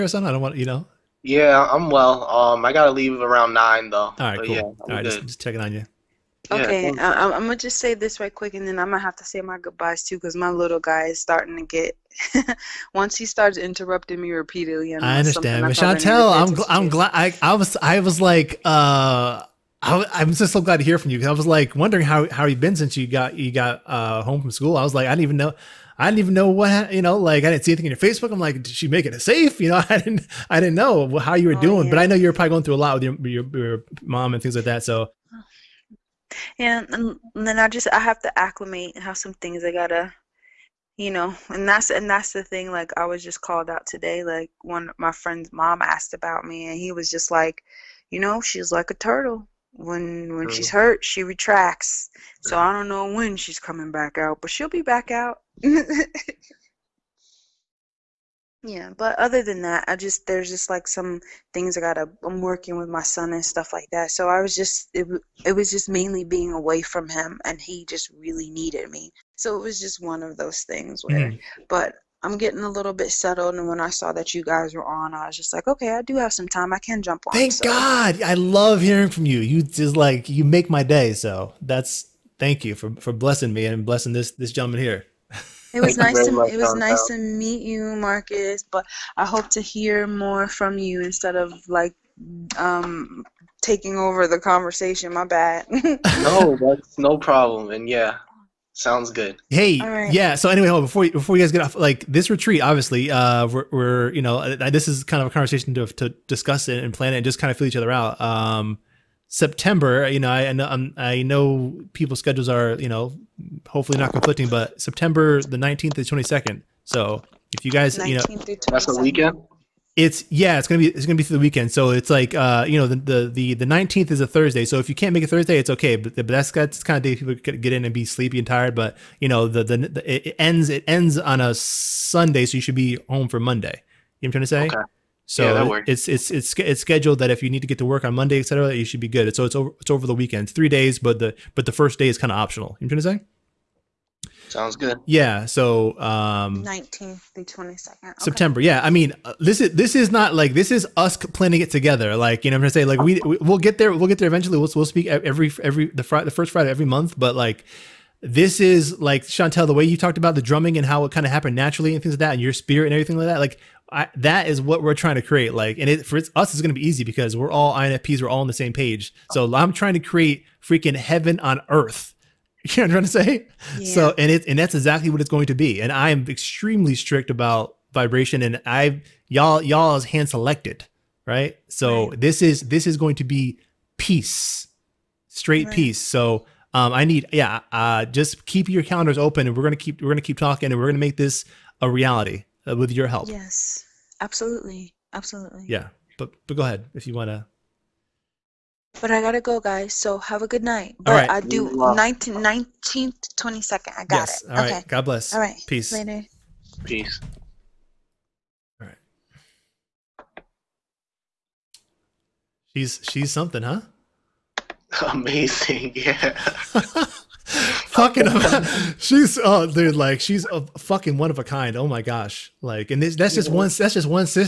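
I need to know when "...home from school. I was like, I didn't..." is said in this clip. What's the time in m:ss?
0:24.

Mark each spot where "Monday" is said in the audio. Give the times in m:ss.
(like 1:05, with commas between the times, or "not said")
2:13, 2:18.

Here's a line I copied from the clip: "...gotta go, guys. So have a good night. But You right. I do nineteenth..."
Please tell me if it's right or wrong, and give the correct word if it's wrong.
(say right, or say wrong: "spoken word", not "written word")
wrong: "All", not "You".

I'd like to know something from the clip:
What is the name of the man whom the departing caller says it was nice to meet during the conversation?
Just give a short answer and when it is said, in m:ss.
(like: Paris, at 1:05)
Marcus, at 1:27.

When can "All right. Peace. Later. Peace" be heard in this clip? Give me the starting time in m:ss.
3:25.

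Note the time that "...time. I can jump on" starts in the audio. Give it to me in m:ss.
1:16.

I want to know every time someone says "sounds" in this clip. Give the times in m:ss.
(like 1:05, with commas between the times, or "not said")
1:38, 2:24.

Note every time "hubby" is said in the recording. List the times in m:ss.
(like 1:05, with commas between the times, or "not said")
not said.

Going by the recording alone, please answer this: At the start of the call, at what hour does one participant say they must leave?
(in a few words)
9.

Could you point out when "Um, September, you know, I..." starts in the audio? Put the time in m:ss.
1:48.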